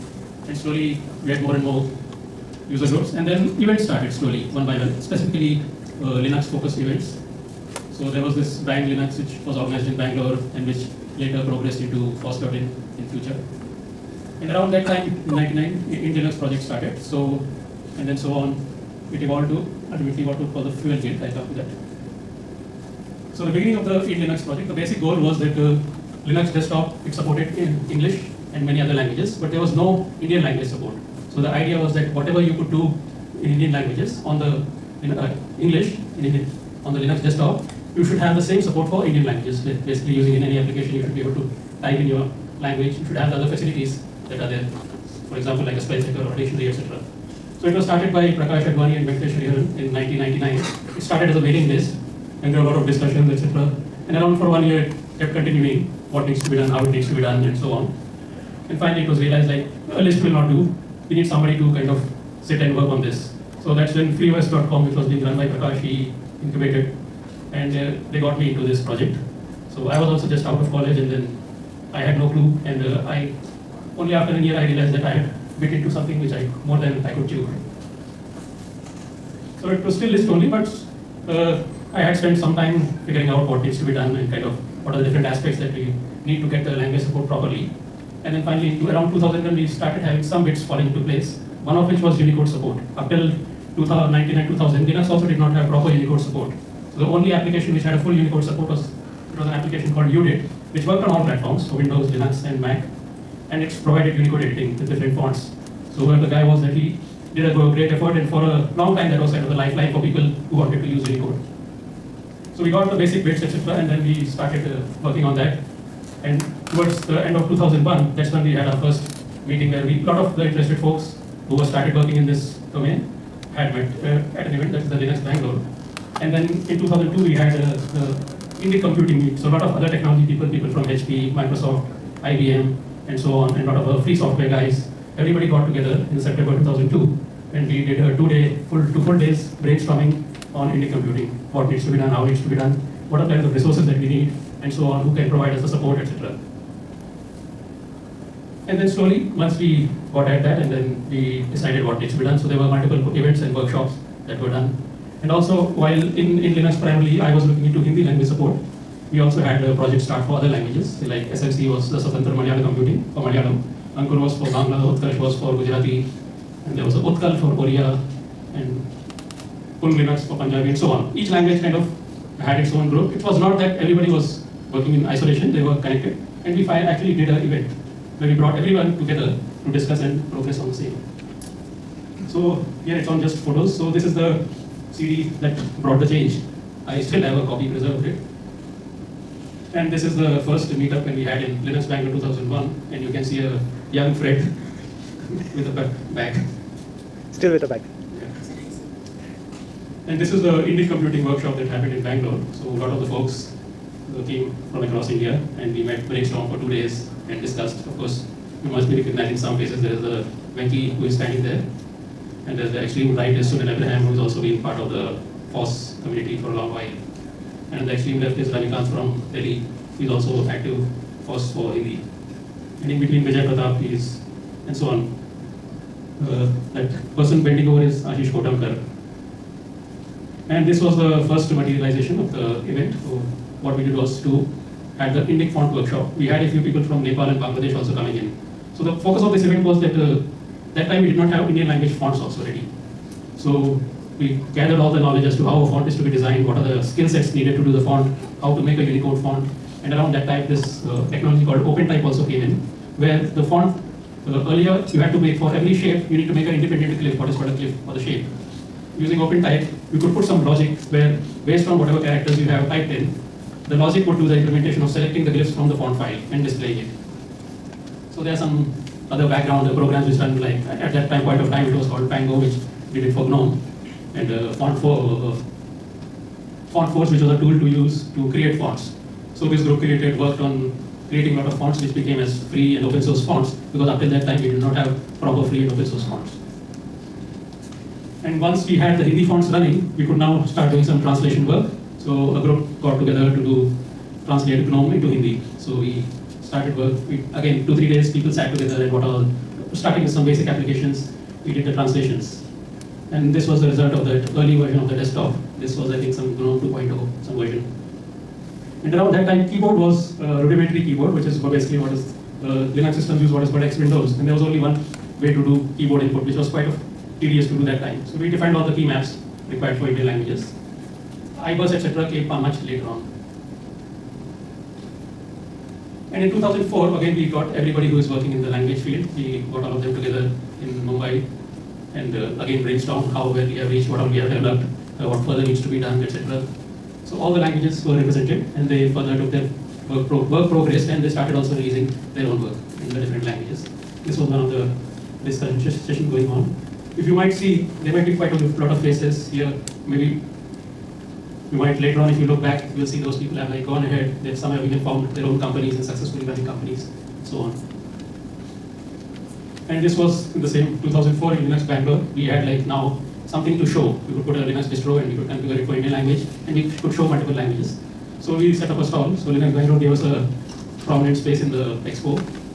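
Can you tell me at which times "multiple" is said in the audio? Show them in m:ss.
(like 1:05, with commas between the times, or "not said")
2:32, 6:07.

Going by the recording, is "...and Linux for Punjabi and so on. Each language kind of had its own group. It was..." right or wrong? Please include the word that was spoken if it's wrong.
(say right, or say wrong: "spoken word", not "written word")
right.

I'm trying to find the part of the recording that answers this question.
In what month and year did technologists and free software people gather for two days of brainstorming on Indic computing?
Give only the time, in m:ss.
2:16.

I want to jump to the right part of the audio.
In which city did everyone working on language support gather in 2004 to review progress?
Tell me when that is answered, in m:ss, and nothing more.
5:30.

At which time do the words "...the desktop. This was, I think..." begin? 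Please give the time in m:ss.
5:04.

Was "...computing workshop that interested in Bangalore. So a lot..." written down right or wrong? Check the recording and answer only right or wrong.
wrong.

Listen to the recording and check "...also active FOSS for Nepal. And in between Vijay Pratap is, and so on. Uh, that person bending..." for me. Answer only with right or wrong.
wrong.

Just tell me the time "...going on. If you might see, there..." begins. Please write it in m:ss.
5:46.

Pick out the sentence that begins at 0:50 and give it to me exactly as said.
It started as a waiting list and there were a lot of discussions, etc.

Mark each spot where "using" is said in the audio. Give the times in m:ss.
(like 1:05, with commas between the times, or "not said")
0:40, 4:18.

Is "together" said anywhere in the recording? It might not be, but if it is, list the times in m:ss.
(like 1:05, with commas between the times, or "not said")
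2:15, 2:58, 4:52, 4:58, 5:29.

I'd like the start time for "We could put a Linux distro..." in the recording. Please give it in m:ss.
6:04.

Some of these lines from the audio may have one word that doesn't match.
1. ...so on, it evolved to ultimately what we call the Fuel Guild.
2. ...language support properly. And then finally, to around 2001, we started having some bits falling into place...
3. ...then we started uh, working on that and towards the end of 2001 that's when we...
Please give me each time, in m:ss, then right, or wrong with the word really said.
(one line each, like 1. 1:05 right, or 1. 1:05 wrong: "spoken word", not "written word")
1. 0:18 right
2. 1:26 right
3. 1:53 right.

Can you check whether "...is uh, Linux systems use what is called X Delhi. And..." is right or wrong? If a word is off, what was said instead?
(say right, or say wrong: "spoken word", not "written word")
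wrong: "Windows", not "Delhi".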